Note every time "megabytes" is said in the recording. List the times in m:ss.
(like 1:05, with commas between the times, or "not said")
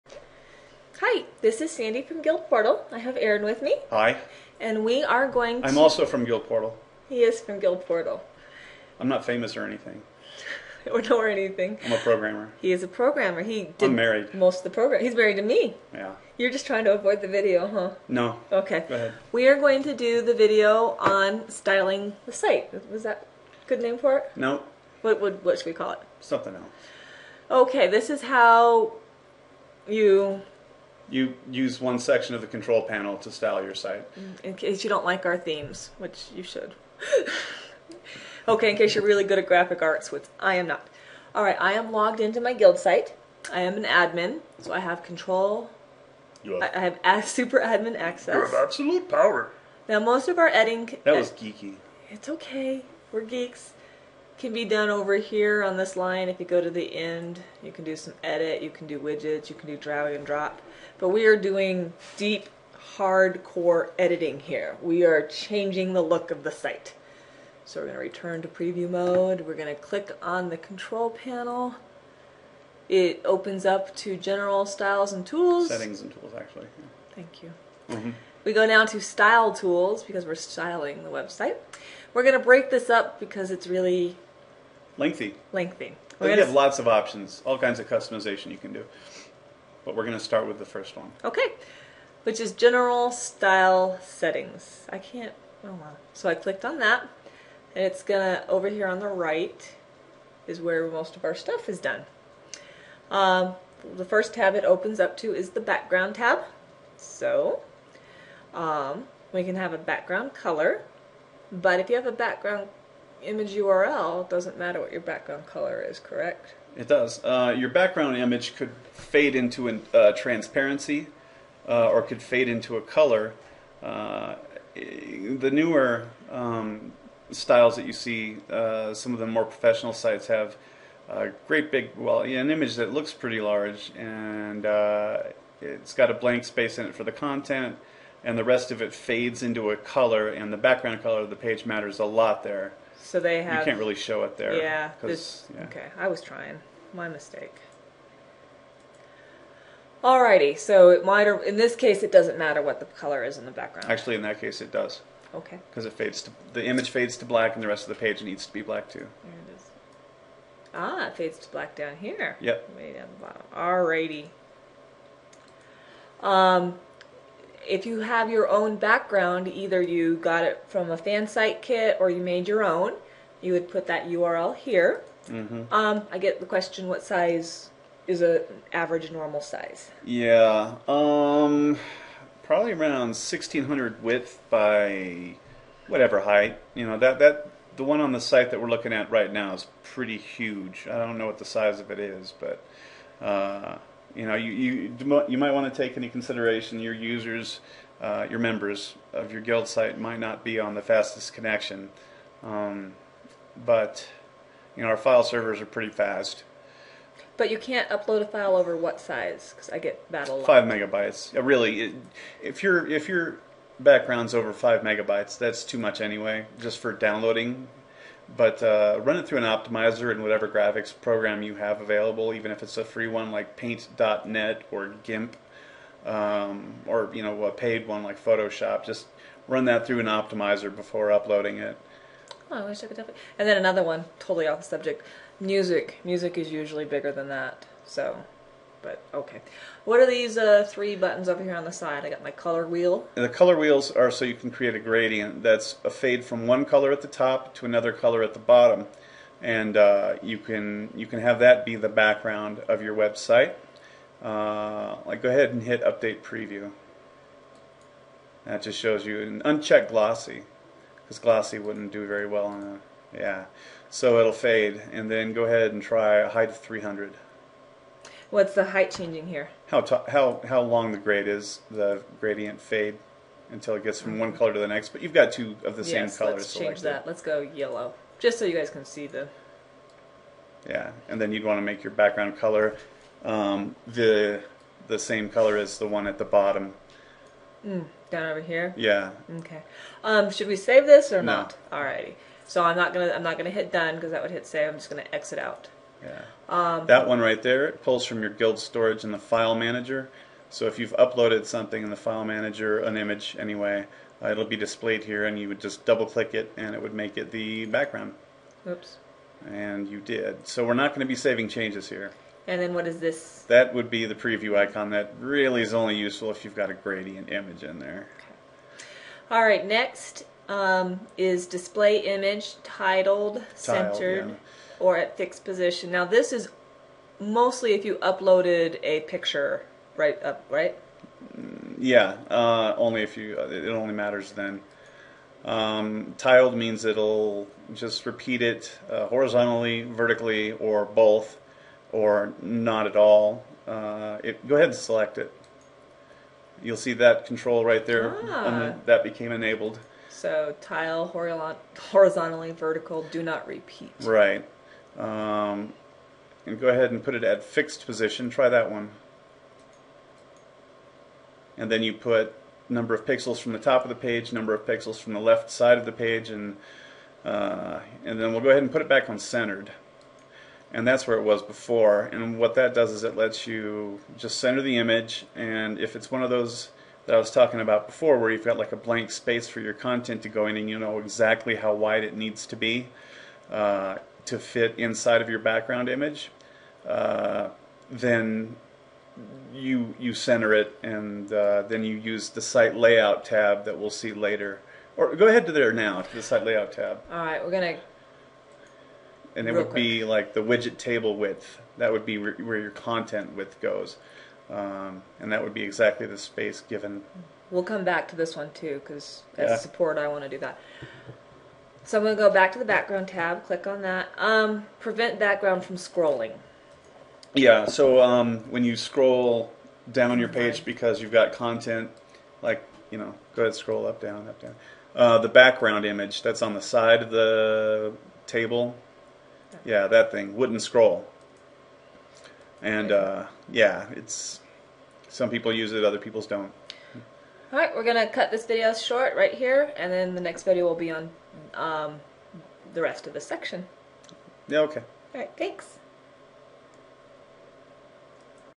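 3:30, 3:34.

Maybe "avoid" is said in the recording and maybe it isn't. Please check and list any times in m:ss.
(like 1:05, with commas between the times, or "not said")
0:16.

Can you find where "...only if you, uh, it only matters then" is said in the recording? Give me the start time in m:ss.
5:32.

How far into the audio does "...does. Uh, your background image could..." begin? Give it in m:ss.
1:56.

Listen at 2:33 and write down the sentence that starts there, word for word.
Actually, in that case, it does.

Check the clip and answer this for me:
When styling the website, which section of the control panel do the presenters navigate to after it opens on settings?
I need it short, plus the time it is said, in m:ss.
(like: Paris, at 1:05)
style tools, at 1:19.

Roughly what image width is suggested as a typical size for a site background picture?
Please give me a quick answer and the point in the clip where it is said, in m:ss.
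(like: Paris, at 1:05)
1600, at 3:03.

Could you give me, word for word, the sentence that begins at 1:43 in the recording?
Um, the first tab it opens up to is the background tab.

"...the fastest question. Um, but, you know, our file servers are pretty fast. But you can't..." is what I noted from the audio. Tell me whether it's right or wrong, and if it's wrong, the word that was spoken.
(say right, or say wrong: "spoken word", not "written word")
wrong: "connection", not "question".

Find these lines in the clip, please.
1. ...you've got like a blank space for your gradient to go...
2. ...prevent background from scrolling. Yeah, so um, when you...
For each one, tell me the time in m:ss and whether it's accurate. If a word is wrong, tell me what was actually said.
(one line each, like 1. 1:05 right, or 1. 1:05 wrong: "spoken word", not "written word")
1. 6:18 wrong: "content", not "gradient"
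2. 6:54 right.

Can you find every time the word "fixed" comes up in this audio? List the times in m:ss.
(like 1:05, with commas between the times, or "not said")
5:25, 5:57.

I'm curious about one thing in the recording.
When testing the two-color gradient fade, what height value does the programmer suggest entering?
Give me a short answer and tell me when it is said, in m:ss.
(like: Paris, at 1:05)
300, at 4:26.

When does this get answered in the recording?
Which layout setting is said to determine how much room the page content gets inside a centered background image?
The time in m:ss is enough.
6:40.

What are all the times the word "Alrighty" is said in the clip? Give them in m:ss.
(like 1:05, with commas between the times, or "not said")
2:30, 2:43, 4:51.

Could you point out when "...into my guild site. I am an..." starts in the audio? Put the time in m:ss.
0:42.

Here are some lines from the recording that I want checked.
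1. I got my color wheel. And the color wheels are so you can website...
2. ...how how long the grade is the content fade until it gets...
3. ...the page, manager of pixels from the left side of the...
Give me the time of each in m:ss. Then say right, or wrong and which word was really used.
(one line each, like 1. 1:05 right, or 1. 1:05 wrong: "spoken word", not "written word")
1. 4:02 wrong: "create", not "website"
2. 4:30 wrong: "gradient", not "content"
3. 6:03 wrong: "number", not "manager".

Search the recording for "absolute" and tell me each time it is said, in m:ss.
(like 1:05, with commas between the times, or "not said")
0:48.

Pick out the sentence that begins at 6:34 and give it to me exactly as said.
Or go ahead to there now, to the site layout tab.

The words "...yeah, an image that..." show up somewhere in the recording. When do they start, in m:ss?
2:12.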